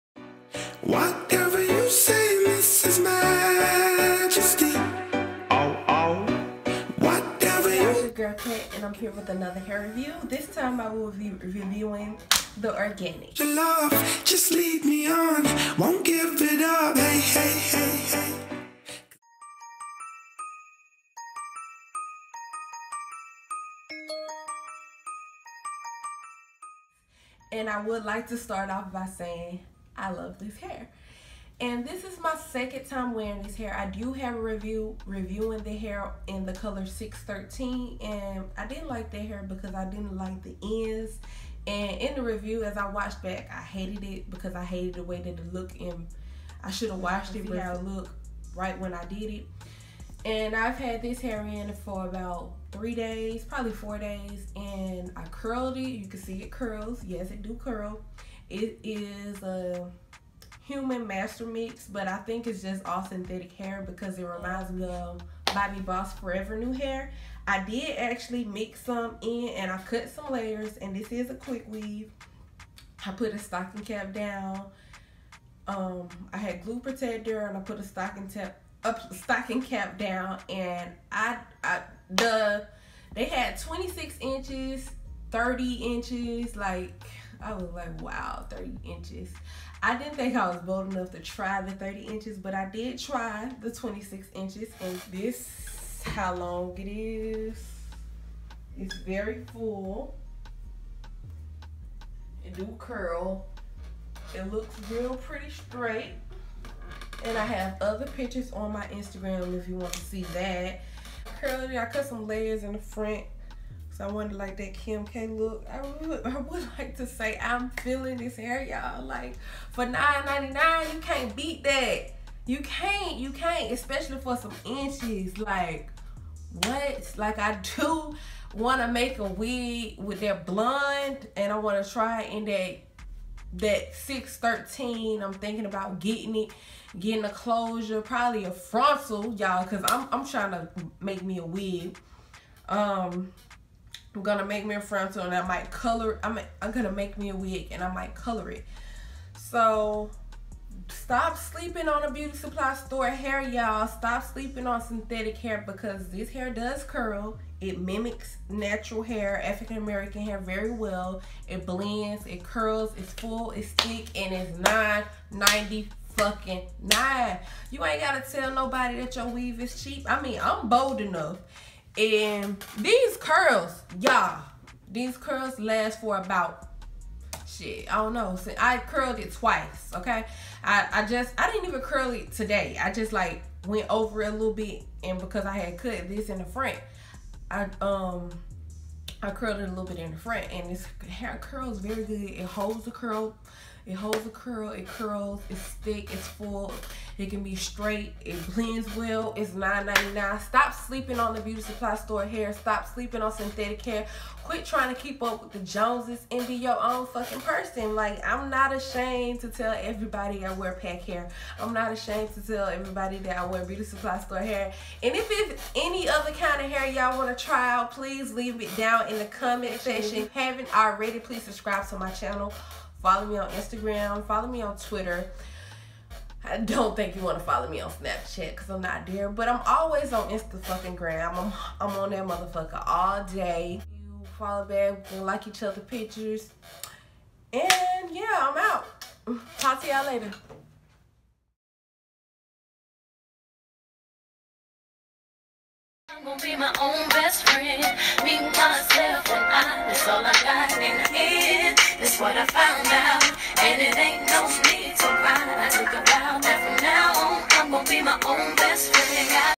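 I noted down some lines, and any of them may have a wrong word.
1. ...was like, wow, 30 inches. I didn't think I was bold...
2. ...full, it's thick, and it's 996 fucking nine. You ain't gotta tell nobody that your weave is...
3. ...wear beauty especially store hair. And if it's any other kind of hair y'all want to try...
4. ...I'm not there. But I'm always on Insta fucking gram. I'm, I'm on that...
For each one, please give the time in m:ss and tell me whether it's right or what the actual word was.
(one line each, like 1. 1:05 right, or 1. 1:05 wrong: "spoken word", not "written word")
1. 1:27 right
2. 2:43 wrong: "990", not "996"
3. 3:33 wrong: "supply", not "especially"
4. 3:48 right.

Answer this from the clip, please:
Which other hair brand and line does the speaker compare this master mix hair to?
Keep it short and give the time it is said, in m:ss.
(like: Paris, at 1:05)
Bobbi Boss Forever Nu Hair, at 1:05.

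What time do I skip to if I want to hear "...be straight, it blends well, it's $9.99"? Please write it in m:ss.
3:17.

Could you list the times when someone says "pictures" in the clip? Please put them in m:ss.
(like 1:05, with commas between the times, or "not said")
1:48, 3:55.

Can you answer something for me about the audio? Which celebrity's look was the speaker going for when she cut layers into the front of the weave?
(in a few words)
Kim K.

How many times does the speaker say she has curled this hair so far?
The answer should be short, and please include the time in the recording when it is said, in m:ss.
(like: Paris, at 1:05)
twice, at 2:59.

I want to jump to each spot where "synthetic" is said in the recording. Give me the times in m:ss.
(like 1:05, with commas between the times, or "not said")
1:03, 2:34, 3:23.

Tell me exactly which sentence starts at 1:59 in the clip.
Like for nine ninety nine, you can't beat that.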